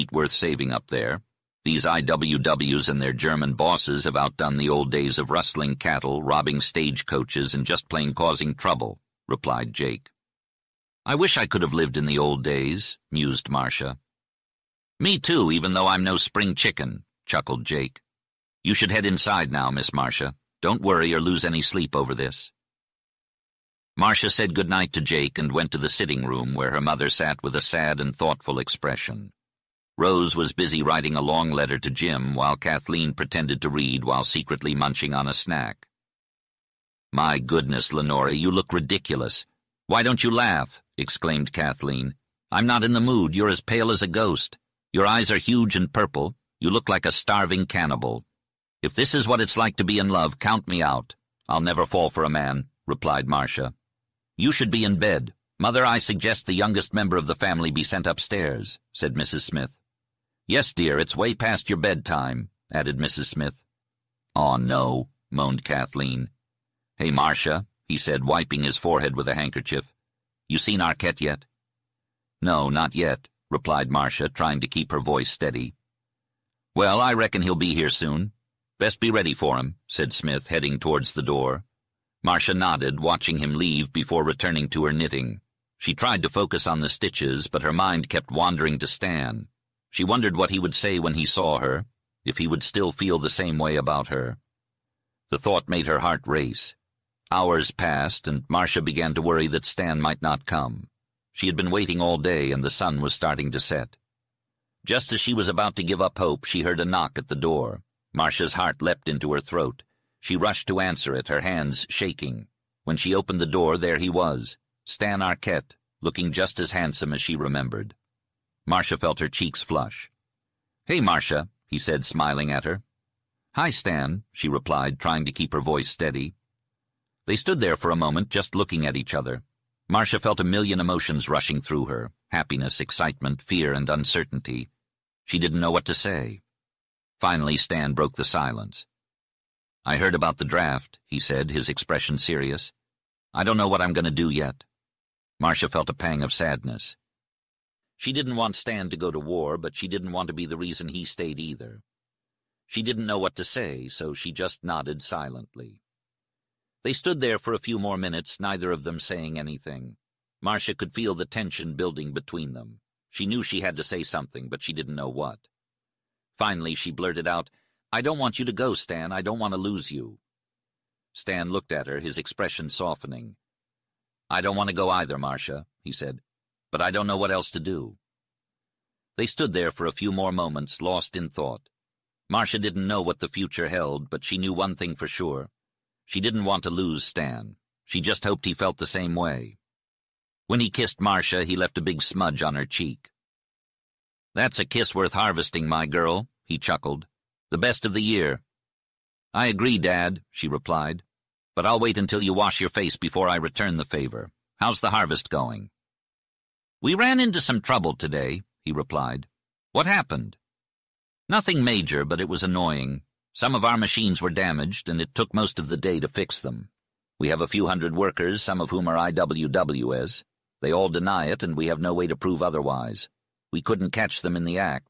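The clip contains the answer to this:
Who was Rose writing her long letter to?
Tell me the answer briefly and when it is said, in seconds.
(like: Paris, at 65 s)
Jim, at 31 s.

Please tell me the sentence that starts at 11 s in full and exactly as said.
I wish I could have lived in the old days, mused Marcia.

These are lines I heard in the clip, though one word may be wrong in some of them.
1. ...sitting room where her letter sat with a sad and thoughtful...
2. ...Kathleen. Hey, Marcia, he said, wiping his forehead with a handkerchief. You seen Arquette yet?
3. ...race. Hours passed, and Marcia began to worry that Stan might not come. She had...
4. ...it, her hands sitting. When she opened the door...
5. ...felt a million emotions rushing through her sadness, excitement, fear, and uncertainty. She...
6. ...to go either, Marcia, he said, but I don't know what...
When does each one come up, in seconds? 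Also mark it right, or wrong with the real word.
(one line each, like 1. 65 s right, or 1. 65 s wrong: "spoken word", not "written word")
1. 25 s wrong: "mother", not "letter"
2. 65 s right
3. 96 s right
4. 111 s wrong: "shaking", not "sitting"
5. 130 s wrong: "happiness", not "sadness"
6. 174 s right.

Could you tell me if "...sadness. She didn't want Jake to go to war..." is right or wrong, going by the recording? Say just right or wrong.
wrong.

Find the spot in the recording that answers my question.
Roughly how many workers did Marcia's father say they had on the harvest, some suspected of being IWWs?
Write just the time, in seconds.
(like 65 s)
217 s.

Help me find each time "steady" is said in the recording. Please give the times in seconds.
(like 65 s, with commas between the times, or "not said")
75 s, 125 s.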